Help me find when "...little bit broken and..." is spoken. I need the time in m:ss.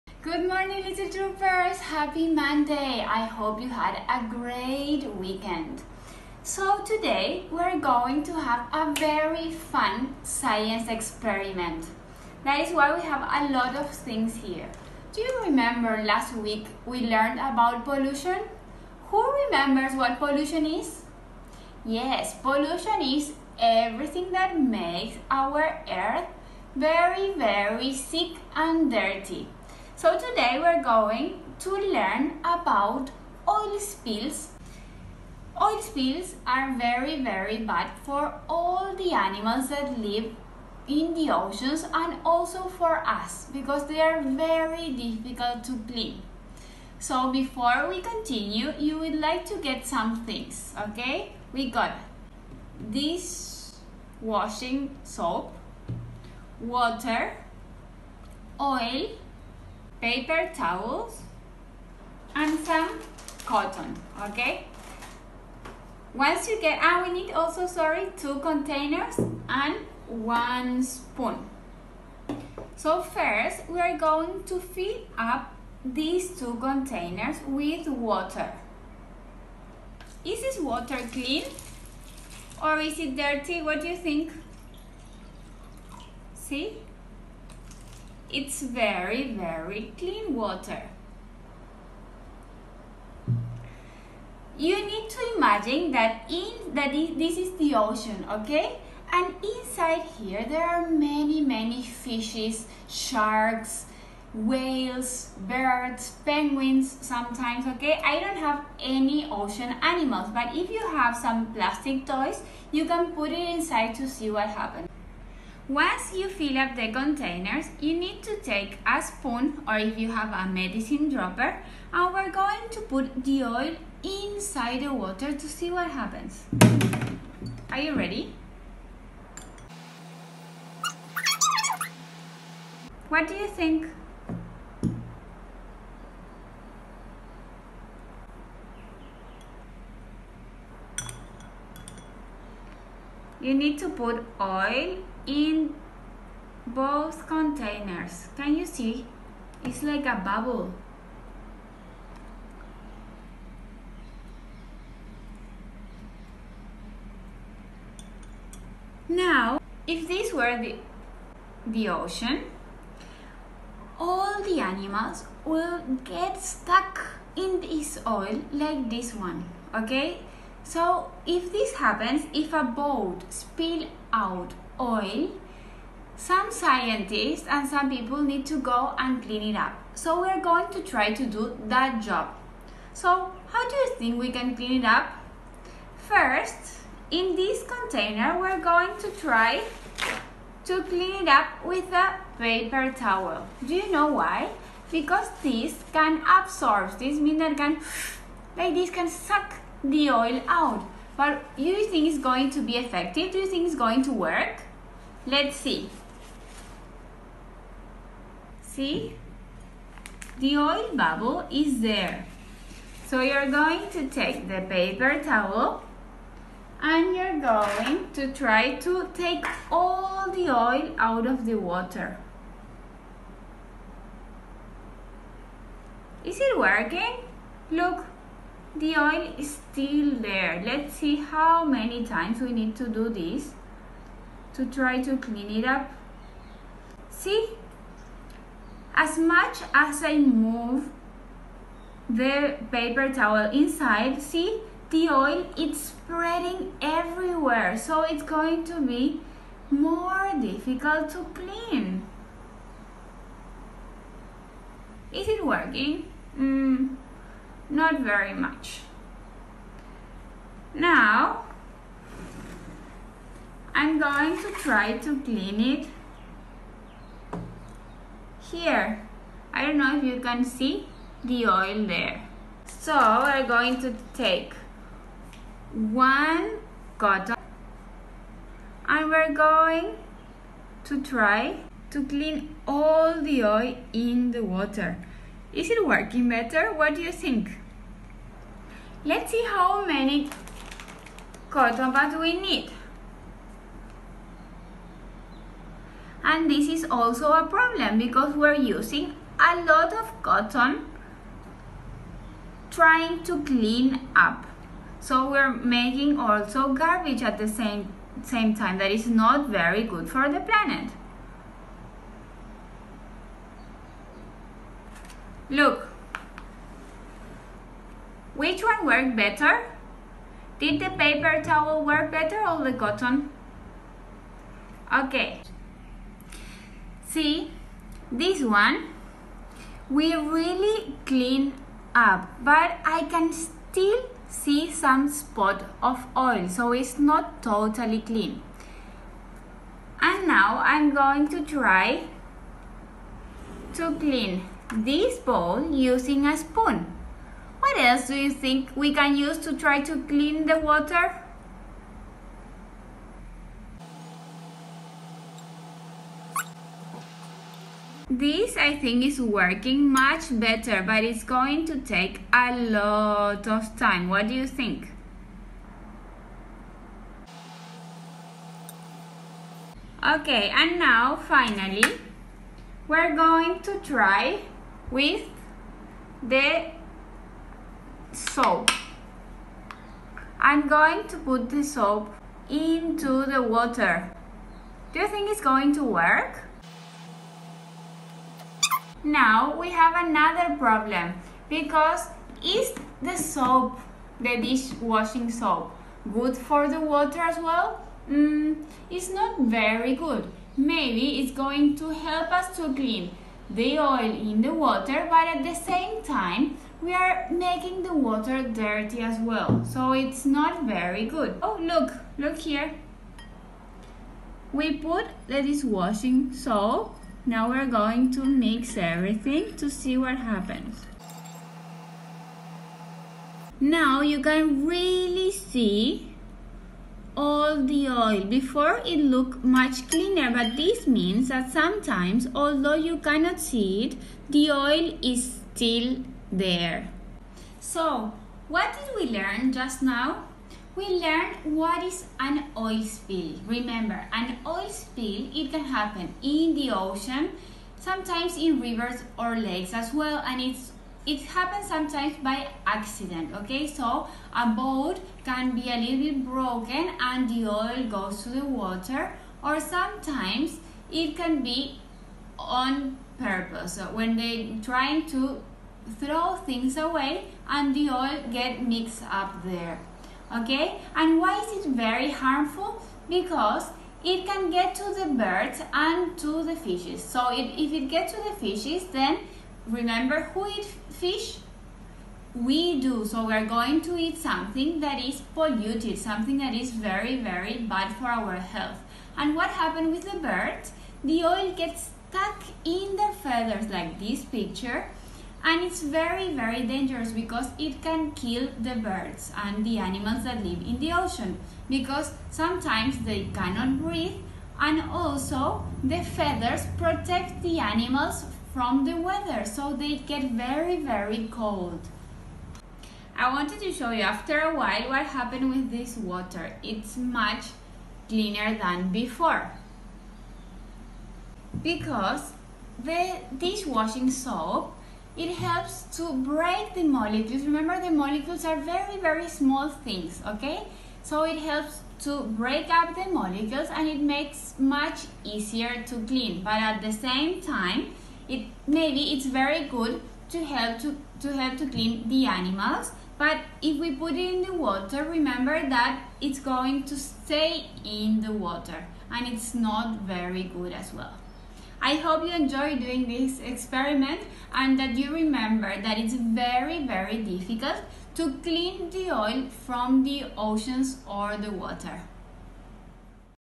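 7:35.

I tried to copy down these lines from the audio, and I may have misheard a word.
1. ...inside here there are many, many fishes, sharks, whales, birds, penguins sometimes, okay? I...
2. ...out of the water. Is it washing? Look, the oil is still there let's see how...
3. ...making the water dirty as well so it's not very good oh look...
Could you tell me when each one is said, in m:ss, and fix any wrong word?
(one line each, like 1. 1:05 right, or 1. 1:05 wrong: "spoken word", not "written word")
1. 1:39 right
2. 3:40 wrong: "working", not "washing"
3. 6:47 right.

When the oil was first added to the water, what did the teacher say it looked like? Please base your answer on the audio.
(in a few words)
A bubble.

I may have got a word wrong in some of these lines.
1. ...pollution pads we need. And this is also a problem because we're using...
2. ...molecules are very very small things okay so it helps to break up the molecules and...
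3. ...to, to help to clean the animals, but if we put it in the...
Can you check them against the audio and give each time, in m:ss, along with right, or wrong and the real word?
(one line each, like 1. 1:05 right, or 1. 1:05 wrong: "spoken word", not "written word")
1. 4:51 wrong: "cotton", not "pollution"
2. 8:47 right
3. 9:00 right.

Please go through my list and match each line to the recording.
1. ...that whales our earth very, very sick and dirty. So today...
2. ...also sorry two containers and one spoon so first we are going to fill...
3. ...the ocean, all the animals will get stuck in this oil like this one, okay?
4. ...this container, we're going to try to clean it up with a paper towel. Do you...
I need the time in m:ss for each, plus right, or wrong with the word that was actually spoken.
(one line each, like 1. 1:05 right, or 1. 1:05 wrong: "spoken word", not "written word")
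1. 0:24 wrong: "makes", not "whales"
2. 1:07 right
3. 2:41 right
4. 3:07 right.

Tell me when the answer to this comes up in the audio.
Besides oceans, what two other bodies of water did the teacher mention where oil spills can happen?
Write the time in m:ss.
7:28.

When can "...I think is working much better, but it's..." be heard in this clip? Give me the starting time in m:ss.
5:58.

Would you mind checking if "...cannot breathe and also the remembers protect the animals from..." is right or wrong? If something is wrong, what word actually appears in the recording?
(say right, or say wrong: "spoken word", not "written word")
wrong: "feathers", not "remembers".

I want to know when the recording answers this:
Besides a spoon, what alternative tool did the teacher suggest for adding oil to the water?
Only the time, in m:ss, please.
2:00.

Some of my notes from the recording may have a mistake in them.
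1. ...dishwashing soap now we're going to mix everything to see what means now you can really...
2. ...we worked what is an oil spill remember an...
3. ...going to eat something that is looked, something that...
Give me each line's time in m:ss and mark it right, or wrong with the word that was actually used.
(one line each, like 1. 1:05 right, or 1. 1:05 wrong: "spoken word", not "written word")
1. 6:55 wrong: "happens", not "means"
2. 7:20 wrong: "learned", not "worked"
3. 8:03 wrong: "polluted", not "looked".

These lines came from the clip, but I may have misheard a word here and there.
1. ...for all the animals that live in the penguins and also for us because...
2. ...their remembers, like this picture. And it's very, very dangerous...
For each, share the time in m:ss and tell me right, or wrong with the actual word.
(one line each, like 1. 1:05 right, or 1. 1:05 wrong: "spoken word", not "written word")
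1. 0:38 wrong: "oceans", not "penguins"
2. 8:12 wrong: "feathers", not "remembers".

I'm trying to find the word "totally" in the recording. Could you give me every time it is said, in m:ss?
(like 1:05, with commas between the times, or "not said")
5:37.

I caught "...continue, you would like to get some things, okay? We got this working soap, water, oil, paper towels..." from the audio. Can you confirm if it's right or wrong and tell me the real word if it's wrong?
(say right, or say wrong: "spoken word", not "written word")
wrong: "washing", not "working".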